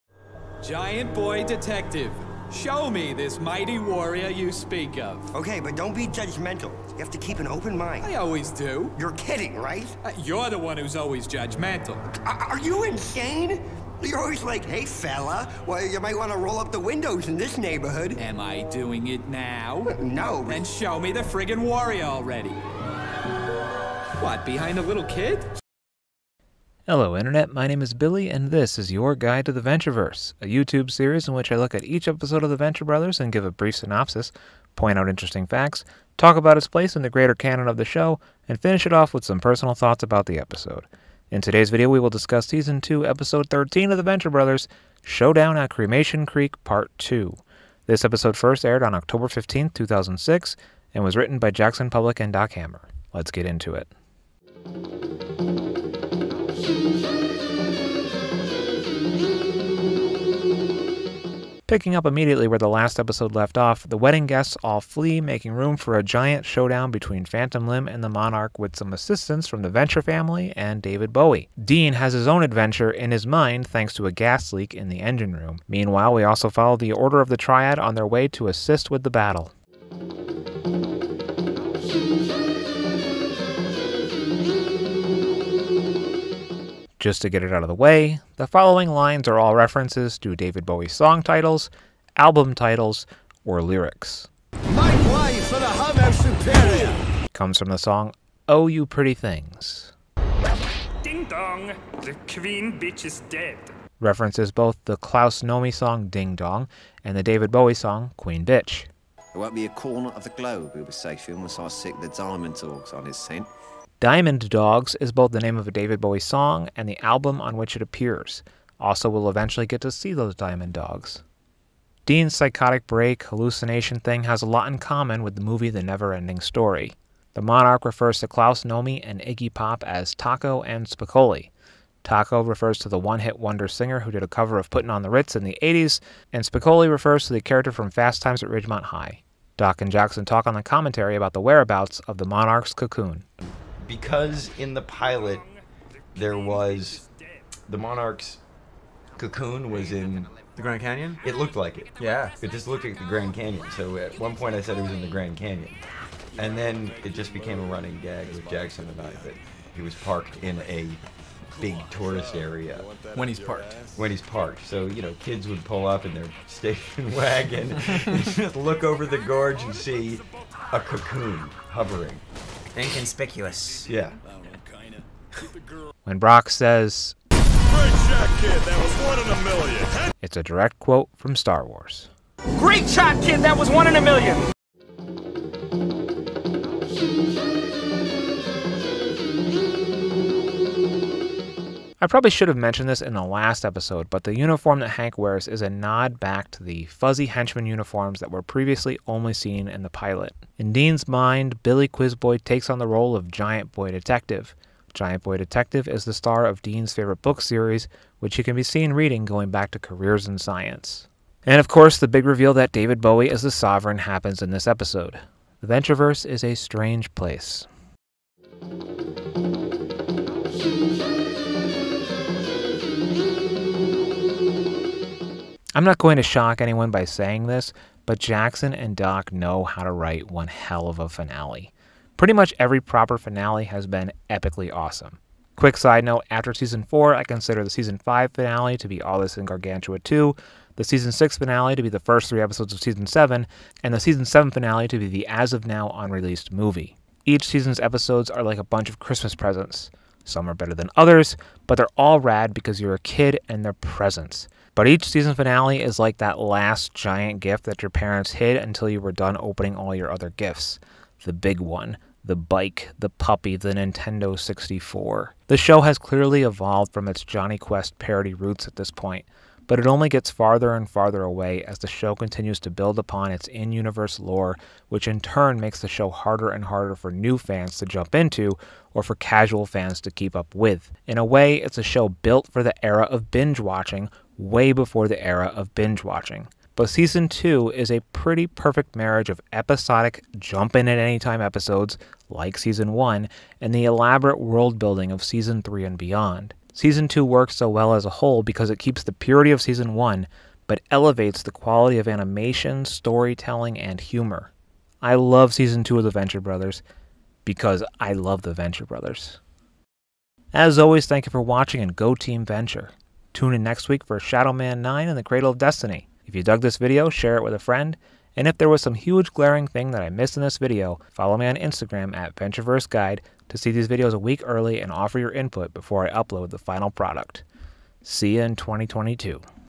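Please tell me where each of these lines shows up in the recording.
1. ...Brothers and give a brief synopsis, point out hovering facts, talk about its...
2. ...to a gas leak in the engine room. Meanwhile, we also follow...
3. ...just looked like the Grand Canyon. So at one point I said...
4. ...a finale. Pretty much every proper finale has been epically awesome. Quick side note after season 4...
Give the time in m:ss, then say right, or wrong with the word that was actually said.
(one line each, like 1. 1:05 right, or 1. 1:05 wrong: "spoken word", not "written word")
1. 0:32 wrong: "interesting", not "hovering"
2. 1:13 right
3. 2:32 right
4. 3:50 right.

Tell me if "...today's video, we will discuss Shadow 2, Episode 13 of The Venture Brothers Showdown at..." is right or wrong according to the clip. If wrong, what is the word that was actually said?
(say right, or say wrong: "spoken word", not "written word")
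wrong: "Season", not "Shadow".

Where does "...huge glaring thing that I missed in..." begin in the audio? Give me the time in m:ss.
5:18.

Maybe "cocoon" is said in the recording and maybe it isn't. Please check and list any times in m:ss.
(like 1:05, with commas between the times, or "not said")
2:22, 2:29, 2:50.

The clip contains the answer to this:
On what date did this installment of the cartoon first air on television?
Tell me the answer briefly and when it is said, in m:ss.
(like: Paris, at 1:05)
October 15, 2006, at 0:48.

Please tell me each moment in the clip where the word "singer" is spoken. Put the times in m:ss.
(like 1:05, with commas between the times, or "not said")
2:13.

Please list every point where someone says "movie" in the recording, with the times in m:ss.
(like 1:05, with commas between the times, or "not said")
2:05, 4:06.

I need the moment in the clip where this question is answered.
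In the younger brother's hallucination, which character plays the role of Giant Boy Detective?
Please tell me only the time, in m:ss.
3:21.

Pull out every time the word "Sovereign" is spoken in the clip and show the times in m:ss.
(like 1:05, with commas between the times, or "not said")
3:33.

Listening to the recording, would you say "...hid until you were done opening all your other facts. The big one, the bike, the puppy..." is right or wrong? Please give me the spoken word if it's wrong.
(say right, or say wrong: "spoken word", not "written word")
wrong: "gifts", not "facts".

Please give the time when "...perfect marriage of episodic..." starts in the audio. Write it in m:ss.
4:48.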